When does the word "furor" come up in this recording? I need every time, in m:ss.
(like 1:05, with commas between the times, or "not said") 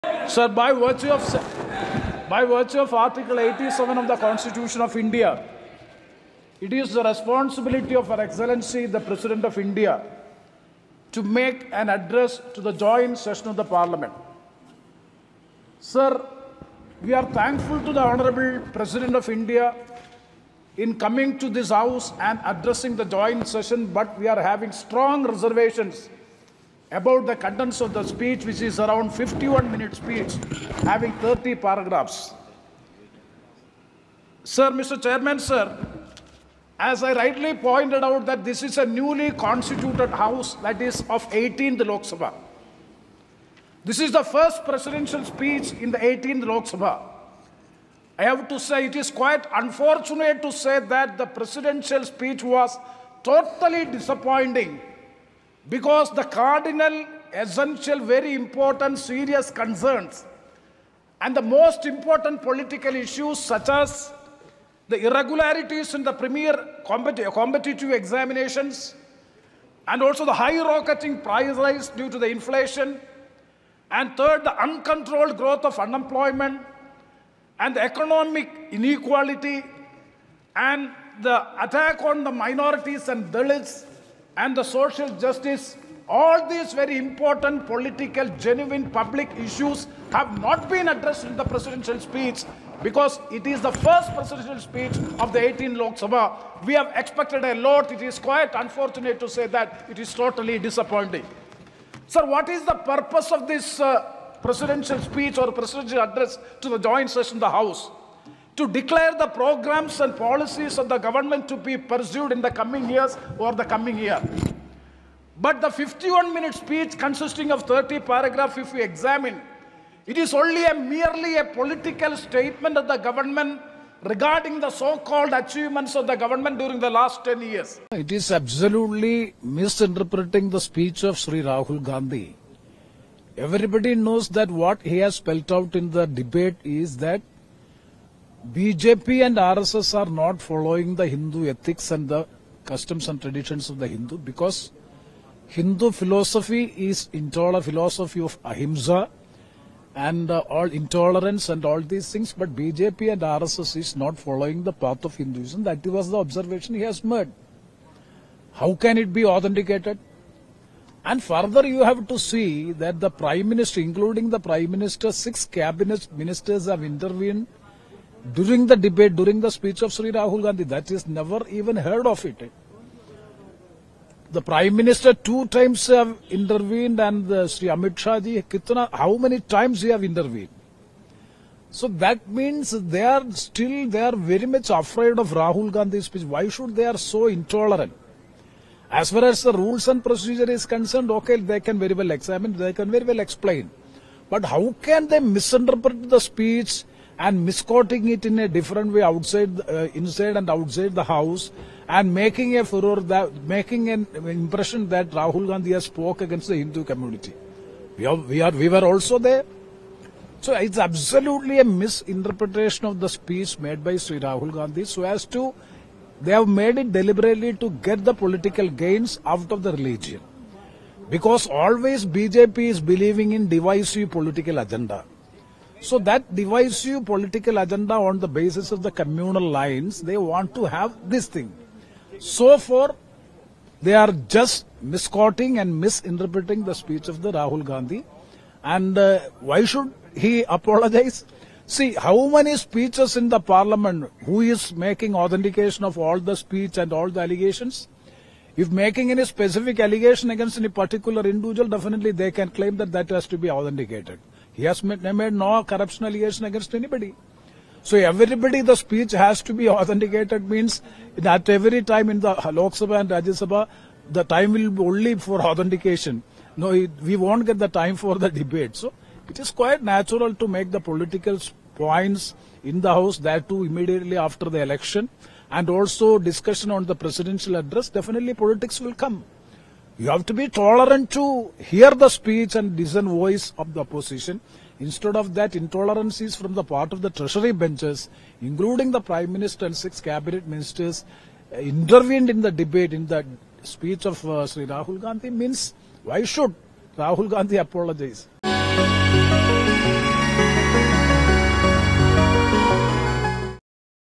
3:22.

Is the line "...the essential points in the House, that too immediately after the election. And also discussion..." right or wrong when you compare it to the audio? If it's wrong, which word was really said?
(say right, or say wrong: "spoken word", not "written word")
wrong: "political", not "essential".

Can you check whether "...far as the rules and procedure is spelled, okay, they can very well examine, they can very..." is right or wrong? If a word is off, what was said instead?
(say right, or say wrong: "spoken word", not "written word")
wrong: "concerned", not "spelled".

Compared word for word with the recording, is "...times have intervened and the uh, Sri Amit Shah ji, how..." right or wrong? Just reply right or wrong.
right.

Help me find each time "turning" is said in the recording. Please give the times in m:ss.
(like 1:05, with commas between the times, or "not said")
not said.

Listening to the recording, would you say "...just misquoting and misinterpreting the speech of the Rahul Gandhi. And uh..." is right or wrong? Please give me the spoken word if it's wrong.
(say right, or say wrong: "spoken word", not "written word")
right.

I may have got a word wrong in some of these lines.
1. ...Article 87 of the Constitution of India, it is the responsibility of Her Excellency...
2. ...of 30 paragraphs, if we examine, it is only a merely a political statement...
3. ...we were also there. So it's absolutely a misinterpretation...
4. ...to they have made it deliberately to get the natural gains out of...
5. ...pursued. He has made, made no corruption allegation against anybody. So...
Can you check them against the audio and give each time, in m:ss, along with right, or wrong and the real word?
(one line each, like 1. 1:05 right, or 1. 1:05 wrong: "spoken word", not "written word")
1. 0:02 right
2. 1:57 right
3. 3:28 right
4. 3:35 wrong: "political", not "natural"
5. 4:13 wrong: "authenticated", not "pursued".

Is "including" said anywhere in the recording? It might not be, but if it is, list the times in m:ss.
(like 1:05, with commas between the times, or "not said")
2:43, 4:48.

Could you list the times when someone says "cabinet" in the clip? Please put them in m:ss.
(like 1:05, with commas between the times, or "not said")
2:45, 4:50.